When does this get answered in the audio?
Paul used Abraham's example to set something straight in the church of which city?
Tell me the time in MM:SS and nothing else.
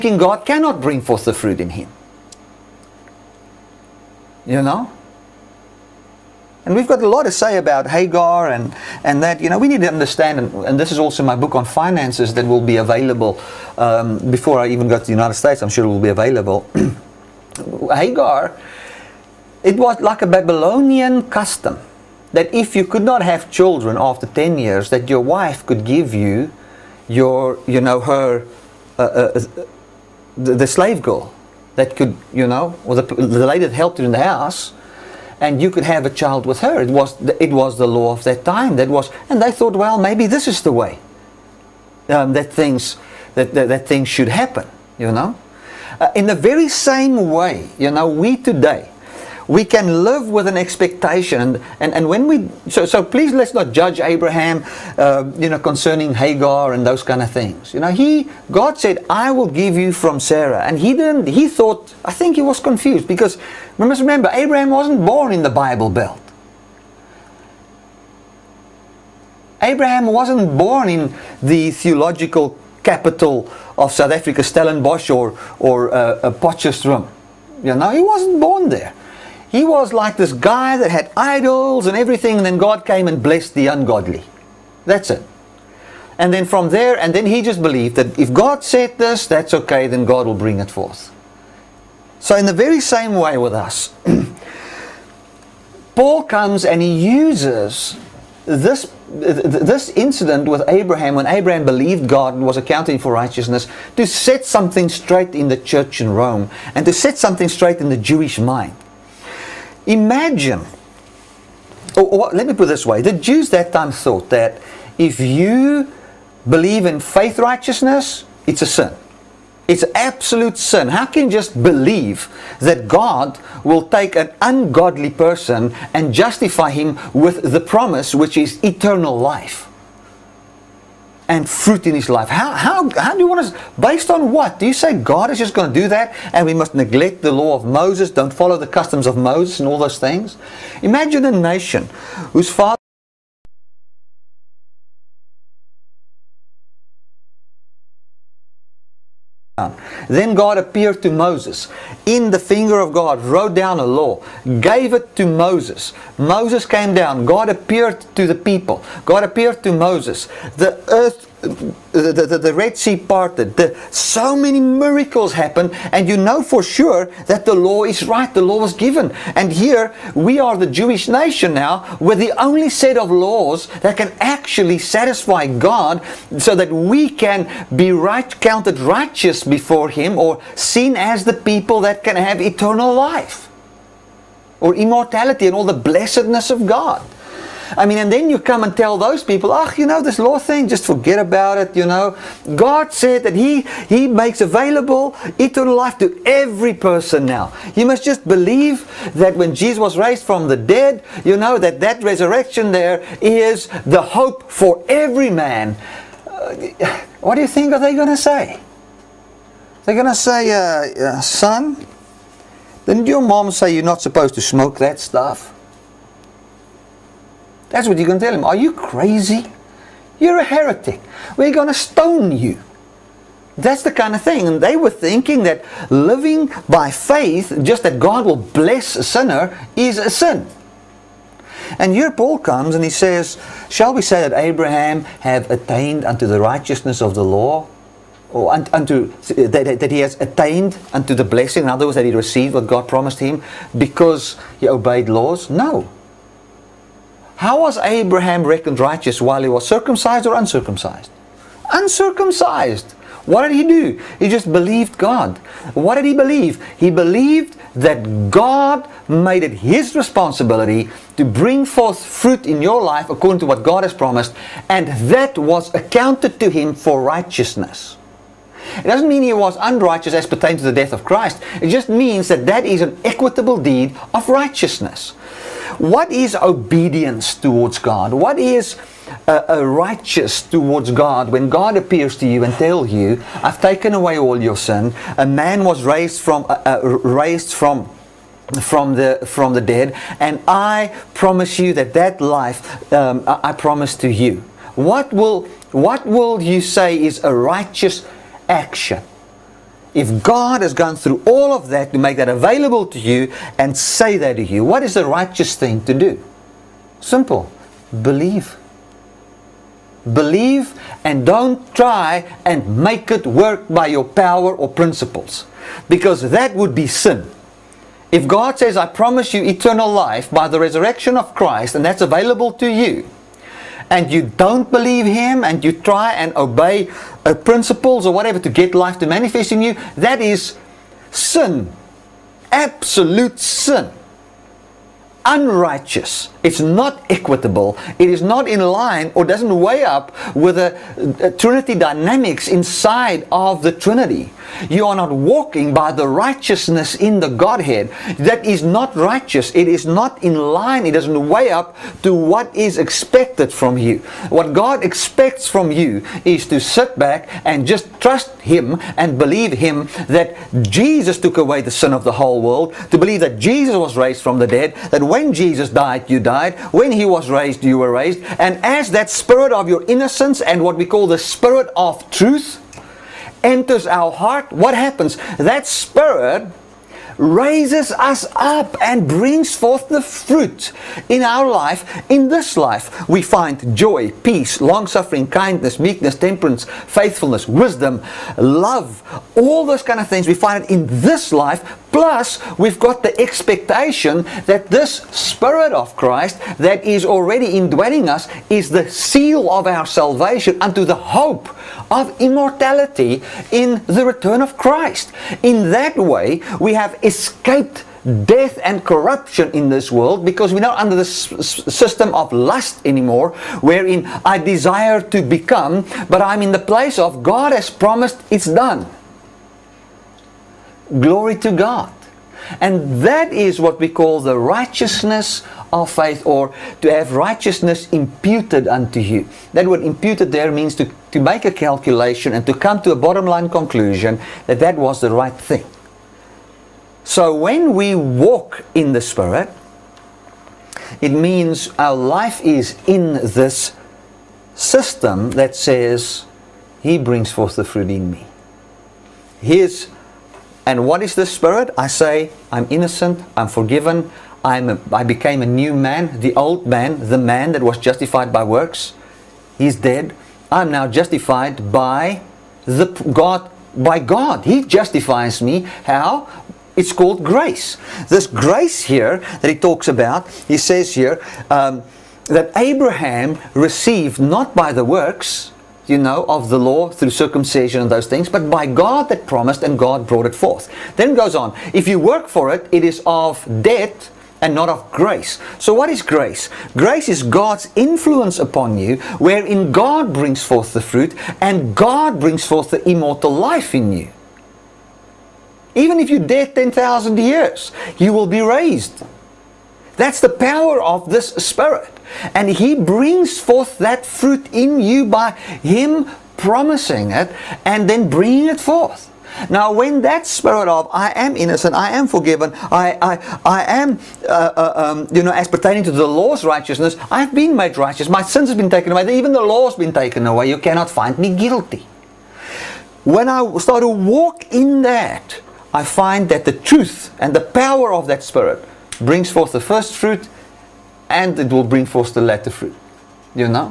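01:46.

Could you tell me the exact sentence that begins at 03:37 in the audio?
That's what you're going to tell him.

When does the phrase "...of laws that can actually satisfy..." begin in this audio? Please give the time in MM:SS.
02:52.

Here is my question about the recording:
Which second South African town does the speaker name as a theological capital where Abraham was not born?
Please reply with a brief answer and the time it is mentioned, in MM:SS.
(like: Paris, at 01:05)
Potchefstroom, at 01:16.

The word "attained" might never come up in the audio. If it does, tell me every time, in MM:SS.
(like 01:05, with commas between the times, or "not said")
03:55, 04:00.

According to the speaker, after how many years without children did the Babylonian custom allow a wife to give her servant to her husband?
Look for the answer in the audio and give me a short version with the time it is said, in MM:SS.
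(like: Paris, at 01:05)
10, at 00:24.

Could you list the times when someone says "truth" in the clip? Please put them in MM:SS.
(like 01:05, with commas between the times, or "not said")
06:12, 08:46.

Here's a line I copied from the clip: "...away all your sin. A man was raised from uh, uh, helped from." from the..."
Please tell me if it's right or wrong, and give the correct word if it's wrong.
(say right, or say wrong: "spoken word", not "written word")
wrong: "raised", not "helped".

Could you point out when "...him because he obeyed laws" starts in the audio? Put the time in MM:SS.
04:03.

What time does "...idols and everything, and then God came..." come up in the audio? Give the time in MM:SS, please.
01:21.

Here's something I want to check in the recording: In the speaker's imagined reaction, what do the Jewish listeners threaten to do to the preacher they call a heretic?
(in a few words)
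Stone you.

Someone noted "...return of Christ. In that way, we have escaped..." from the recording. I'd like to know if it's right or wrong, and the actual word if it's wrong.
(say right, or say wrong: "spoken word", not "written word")
right.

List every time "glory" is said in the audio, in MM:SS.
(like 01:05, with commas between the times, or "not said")
07:00.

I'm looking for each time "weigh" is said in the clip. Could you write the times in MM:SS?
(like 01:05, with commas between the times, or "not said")
05:39, 05:51.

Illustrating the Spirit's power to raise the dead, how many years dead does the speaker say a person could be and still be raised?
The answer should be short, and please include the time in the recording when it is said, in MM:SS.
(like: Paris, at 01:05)
10,000, at 08:16.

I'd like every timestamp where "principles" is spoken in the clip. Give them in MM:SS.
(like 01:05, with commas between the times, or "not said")
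05:14, 05:27.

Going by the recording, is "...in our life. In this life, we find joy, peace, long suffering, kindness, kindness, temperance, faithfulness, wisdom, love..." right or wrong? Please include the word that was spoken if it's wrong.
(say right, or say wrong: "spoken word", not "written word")
wrong: "meekness", not "kindness".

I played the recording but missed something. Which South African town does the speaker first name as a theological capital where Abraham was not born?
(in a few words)
Stellenbosch.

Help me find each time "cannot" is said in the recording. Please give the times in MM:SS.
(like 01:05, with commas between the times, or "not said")
00:00, 08:40.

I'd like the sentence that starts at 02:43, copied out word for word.
The, so many miracles happen, and you know for sure that the law is right.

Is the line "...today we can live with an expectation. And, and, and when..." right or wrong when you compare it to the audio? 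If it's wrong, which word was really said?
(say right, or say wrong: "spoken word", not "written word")
right.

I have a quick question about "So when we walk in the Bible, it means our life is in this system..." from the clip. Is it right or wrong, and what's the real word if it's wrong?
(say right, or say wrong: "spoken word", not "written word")
wrong: "Spirit", not "Bible".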